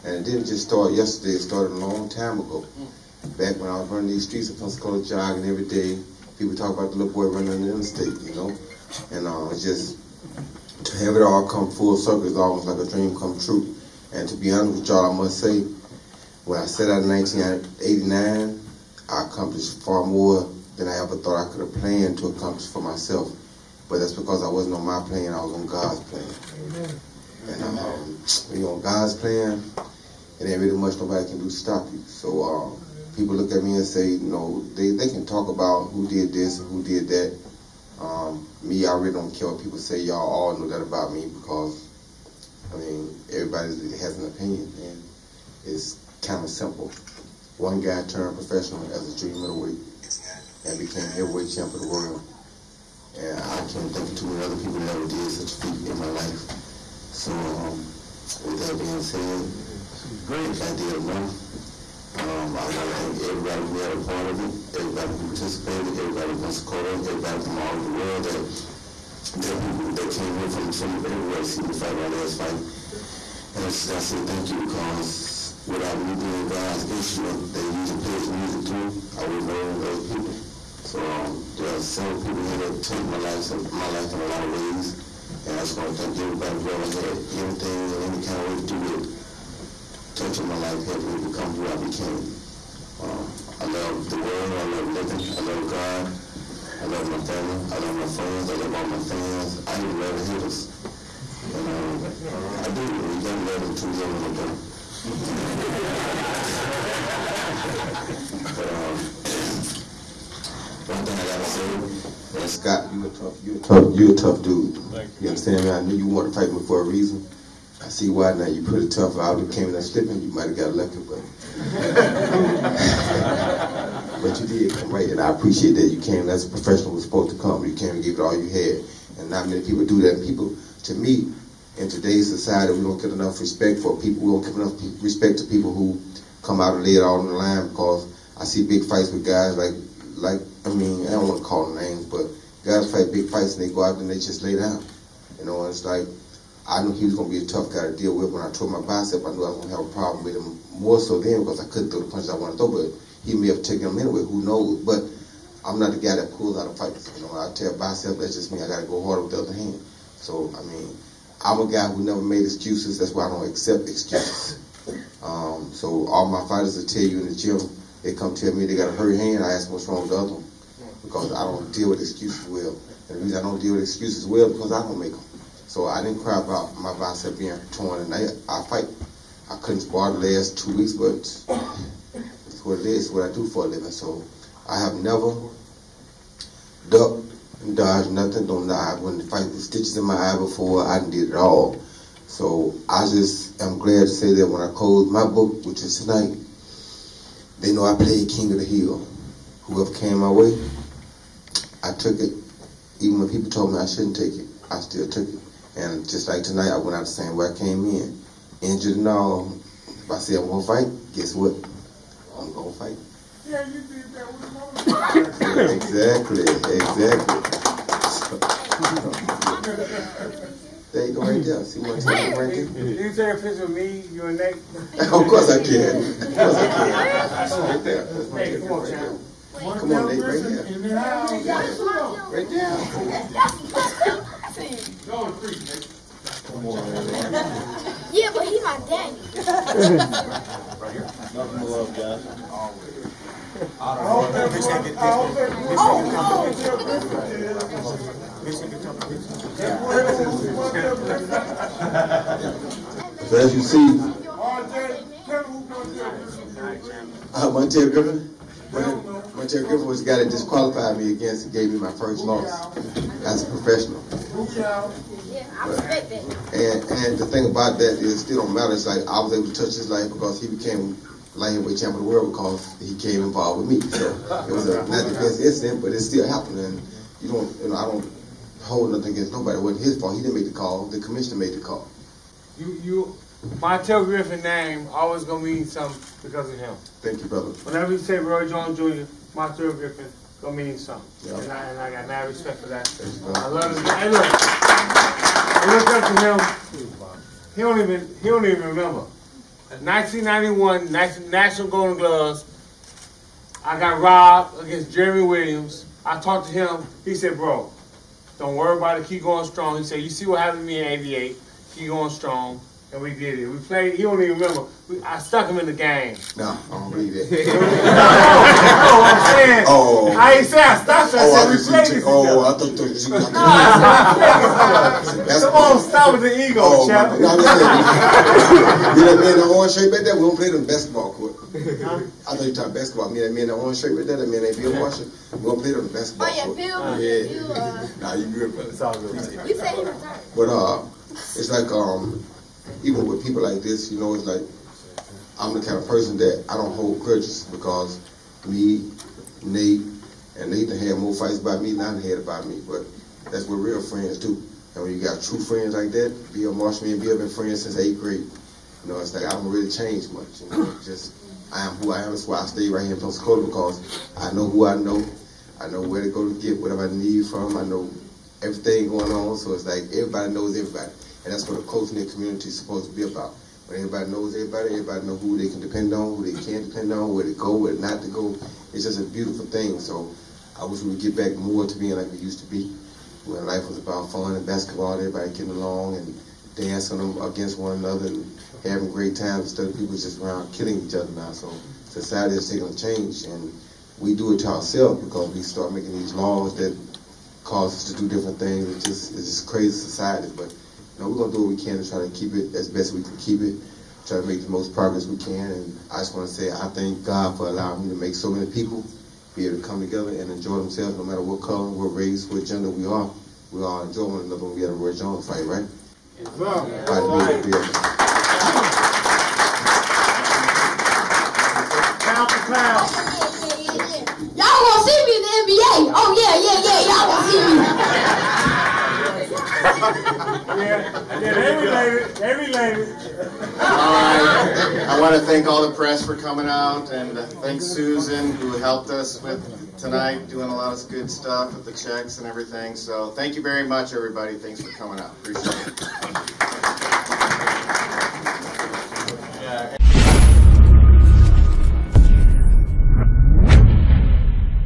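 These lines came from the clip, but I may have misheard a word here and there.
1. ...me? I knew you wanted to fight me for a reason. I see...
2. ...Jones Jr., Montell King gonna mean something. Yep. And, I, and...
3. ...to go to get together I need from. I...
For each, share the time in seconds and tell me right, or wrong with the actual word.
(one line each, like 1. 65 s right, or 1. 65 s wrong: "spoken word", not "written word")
1. 115 s right
2. 288 s wrong: "Griffin", not "King"
3. 366 s wrong: "whatever", not "together".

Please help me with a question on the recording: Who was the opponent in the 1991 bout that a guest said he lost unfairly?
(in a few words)
Jeremy Williams.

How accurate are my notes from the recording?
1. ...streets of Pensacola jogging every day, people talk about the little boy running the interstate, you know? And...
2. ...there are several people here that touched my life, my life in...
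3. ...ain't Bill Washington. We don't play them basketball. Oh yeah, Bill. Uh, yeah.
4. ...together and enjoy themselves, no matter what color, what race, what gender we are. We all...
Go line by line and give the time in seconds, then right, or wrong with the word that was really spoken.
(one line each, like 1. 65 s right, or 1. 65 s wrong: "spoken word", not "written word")
1. 4 s right
2. 81 s right
3. 334 s right
4. 409 s right.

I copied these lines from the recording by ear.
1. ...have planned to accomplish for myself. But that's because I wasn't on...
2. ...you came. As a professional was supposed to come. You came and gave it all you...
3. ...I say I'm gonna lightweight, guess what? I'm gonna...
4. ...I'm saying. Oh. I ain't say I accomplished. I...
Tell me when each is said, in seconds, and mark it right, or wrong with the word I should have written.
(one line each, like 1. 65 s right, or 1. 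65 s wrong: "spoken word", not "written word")
1. 21 s right
2. 125 s right
3. 210 s wrong: "fight", not "lightweight"
4. 319 s wrong: "stopped", not "accomplished".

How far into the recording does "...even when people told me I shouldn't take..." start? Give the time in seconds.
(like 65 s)
203 s.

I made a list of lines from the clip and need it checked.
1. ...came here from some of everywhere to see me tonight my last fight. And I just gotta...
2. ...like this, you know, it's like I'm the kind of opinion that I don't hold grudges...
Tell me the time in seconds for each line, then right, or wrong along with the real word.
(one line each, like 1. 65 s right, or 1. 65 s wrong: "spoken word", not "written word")
1. 70 s wrong: "fight", not "tonight"
2. 343 s wrong: "person", not "opinion".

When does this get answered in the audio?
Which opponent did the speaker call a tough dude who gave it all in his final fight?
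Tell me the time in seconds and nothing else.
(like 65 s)
112 s.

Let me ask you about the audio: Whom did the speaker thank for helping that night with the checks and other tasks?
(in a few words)
Susan.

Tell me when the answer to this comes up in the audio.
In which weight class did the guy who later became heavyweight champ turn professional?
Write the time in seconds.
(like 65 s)
49 s.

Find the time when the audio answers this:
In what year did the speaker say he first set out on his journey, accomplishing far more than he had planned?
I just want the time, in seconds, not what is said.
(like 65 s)
17 s.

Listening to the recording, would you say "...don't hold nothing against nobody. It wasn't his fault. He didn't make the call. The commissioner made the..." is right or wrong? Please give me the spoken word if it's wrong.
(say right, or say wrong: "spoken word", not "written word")
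right.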